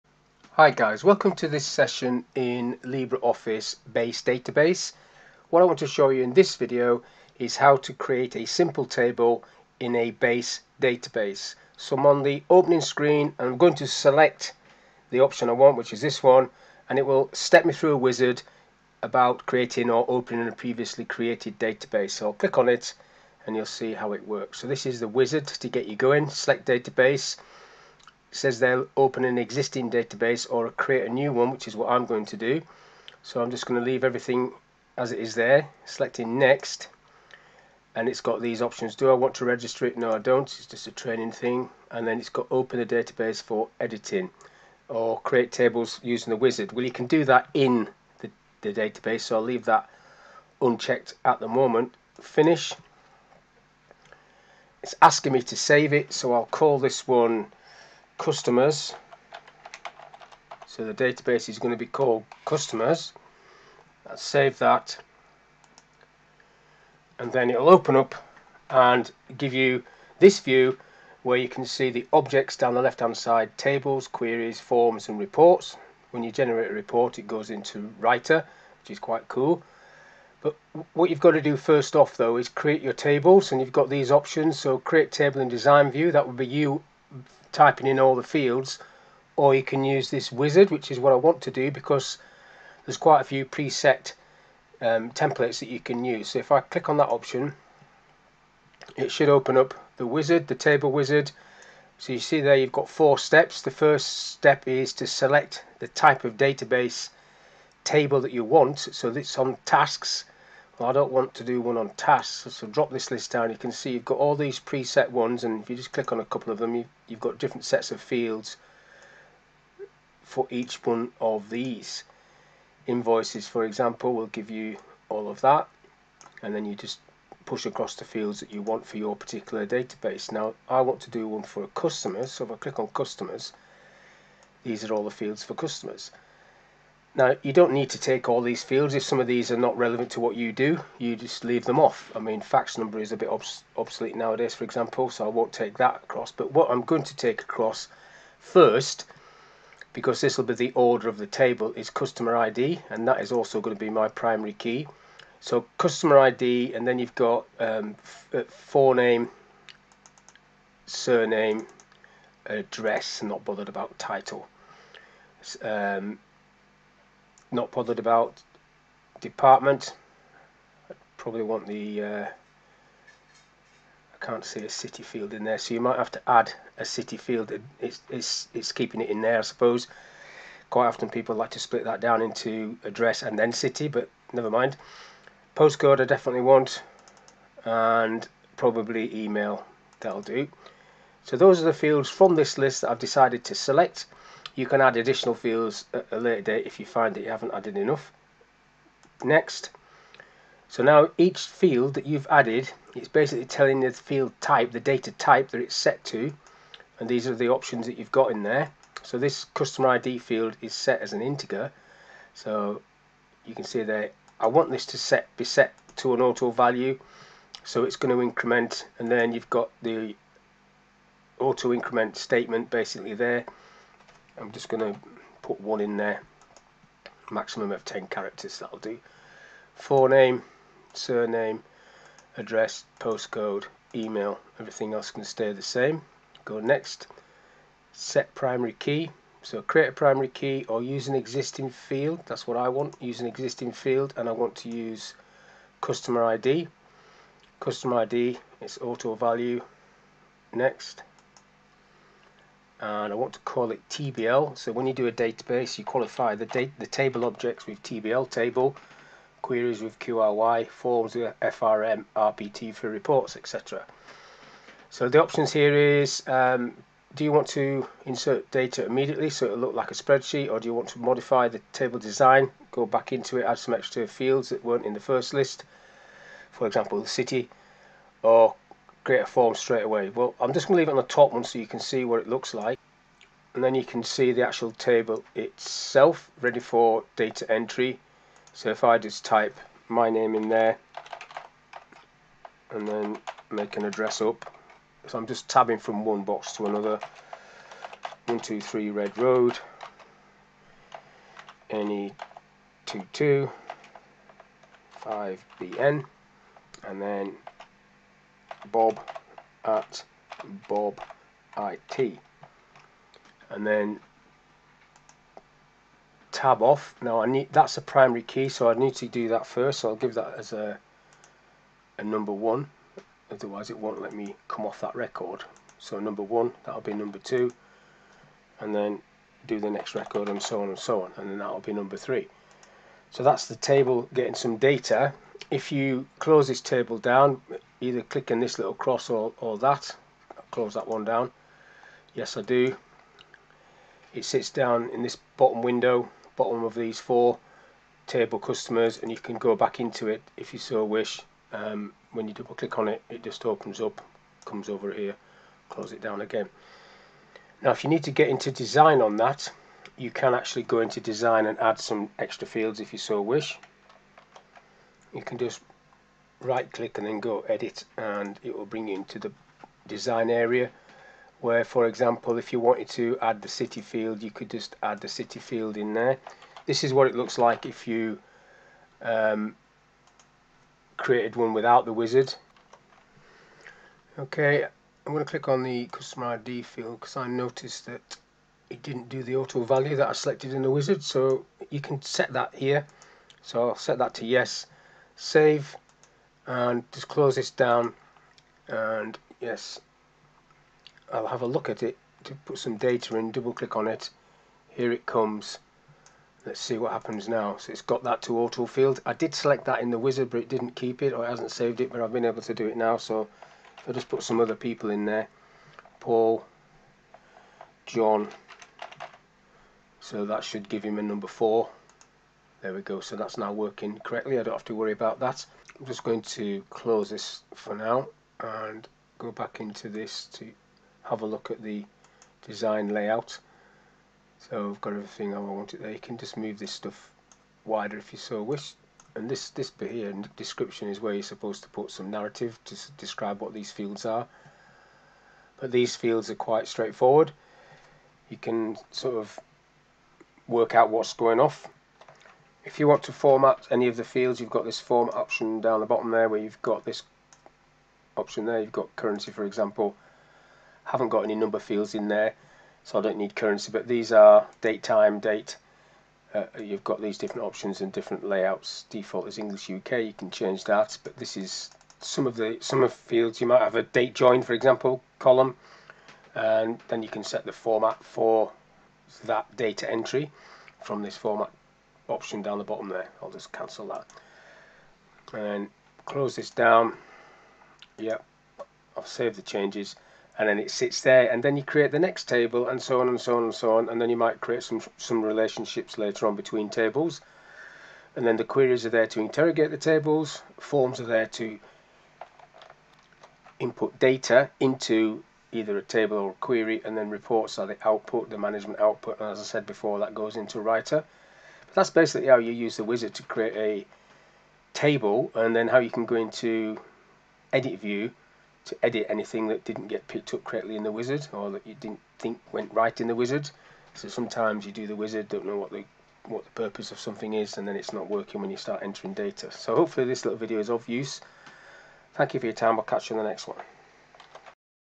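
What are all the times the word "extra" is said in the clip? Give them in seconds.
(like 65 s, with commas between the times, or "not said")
273 s, 362 s.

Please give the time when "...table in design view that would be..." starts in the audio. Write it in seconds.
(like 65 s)
85 s.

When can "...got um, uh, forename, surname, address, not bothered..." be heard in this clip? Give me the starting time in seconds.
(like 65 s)
157 s.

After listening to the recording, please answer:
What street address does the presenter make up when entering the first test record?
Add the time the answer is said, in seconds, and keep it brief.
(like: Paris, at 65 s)
123 Red Road, at 298 s.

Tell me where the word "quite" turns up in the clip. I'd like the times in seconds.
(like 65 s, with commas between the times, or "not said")
78 s, 92 s, 180 s, 446 s.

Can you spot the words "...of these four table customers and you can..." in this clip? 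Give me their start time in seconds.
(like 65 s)
346 s.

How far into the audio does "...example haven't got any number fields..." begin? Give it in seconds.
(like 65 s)
459 s.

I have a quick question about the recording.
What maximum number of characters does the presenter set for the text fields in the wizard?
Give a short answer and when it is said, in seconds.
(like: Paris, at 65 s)
10, at 227 s.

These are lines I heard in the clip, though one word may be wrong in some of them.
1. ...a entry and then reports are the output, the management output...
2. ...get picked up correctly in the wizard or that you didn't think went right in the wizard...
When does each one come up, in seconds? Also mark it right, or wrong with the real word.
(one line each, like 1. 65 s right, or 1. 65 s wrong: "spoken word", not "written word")
1. 506 s wrong: "query", not "entry"
2. 519 s right.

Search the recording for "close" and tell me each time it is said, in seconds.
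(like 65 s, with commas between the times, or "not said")
336 s, 340 s, 355 s, 397 s, 426 s, 486 s.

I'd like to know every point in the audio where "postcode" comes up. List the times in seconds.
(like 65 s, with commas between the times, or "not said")
185 s, 232 s.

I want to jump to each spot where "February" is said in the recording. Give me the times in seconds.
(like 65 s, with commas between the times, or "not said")
not said.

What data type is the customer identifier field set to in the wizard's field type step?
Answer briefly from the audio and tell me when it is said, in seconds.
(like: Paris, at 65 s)
integer, at 211 s.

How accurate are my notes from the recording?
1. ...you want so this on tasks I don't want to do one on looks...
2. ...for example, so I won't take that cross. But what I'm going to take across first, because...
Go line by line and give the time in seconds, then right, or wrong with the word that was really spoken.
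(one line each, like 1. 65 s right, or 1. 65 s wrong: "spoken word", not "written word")
1. 108 s wrong: "tasks", not "looks"
2. 144 s wrong: "across", not "cross".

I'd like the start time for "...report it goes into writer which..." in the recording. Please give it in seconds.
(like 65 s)
76 s.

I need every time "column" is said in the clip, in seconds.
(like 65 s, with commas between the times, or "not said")
475 s.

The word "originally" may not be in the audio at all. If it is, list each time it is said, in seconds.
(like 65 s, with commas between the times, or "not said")
not said.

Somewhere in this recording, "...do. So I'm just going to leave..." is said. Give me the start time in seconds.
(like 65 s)
32 s.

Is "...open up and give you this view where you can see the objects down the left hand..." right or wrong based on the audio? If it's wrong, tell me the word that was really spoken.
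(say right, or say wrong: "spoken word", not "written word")
right.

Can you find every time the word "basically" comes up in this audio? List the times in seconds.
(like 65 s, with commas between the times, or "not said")
203 s, 222 s, 511 s.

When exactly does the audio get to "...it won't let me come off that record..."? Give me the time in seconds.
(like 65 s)
323 s.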